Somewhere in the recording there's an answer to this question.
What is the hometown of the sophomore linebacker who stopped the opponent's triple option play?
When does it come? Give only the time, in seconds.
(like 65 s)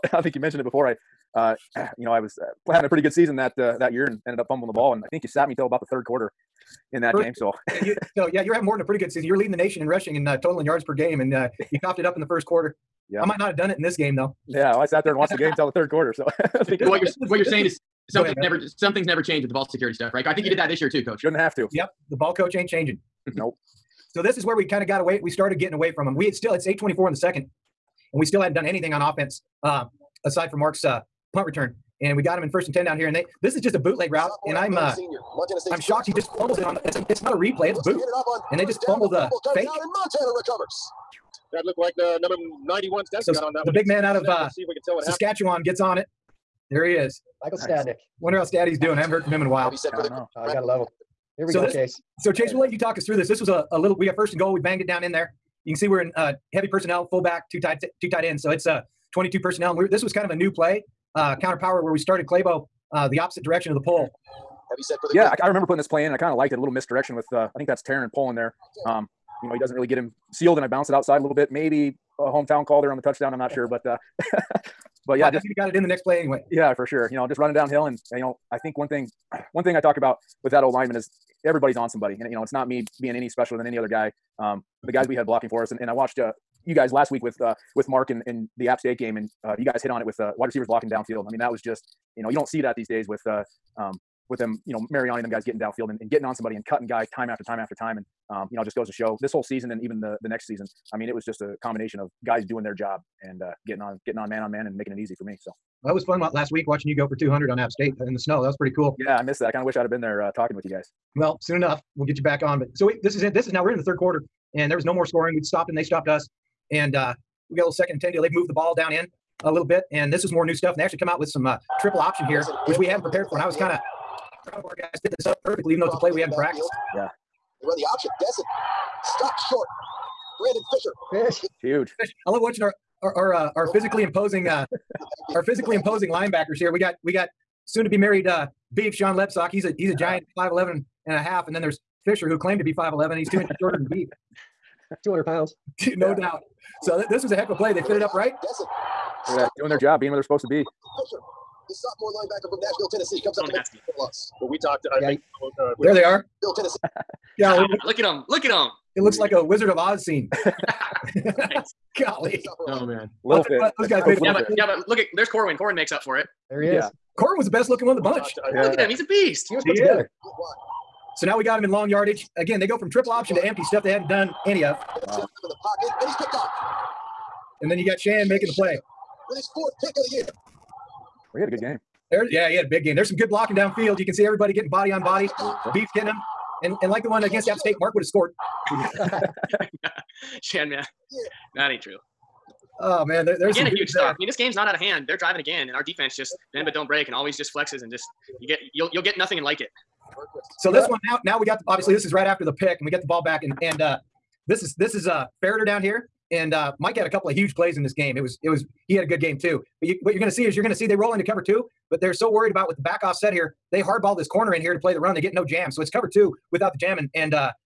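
152 s.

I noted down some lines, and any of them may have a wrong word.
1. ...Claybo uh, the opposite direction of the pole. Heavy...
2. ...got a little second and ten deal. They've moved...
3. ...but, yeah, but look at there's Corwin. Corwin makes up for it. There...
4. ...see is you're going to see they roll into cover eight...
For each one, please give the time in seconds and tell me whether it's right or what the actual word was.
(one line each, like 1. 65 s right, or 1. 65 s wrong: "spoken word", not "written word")
1. 62 s right
2. 117 s right
3. 164 s right
4. 210 s wrong: "two", not "eight".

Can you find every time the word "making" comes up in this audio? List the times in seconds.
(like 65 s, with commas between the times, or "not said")
104 s, 178 s.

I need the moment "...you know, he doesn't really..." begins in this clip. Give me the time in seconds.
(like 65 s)
69 s.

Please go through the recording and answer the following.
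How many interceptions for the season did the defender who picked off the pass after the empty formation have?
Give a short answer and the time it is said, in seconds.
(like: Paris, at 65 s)
4, at 179 s.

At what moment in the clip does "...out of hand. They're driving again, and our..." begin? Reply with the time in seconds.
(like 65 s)
194 s.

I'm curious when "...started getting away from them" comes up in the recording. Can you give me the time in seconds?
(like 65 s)
25 s.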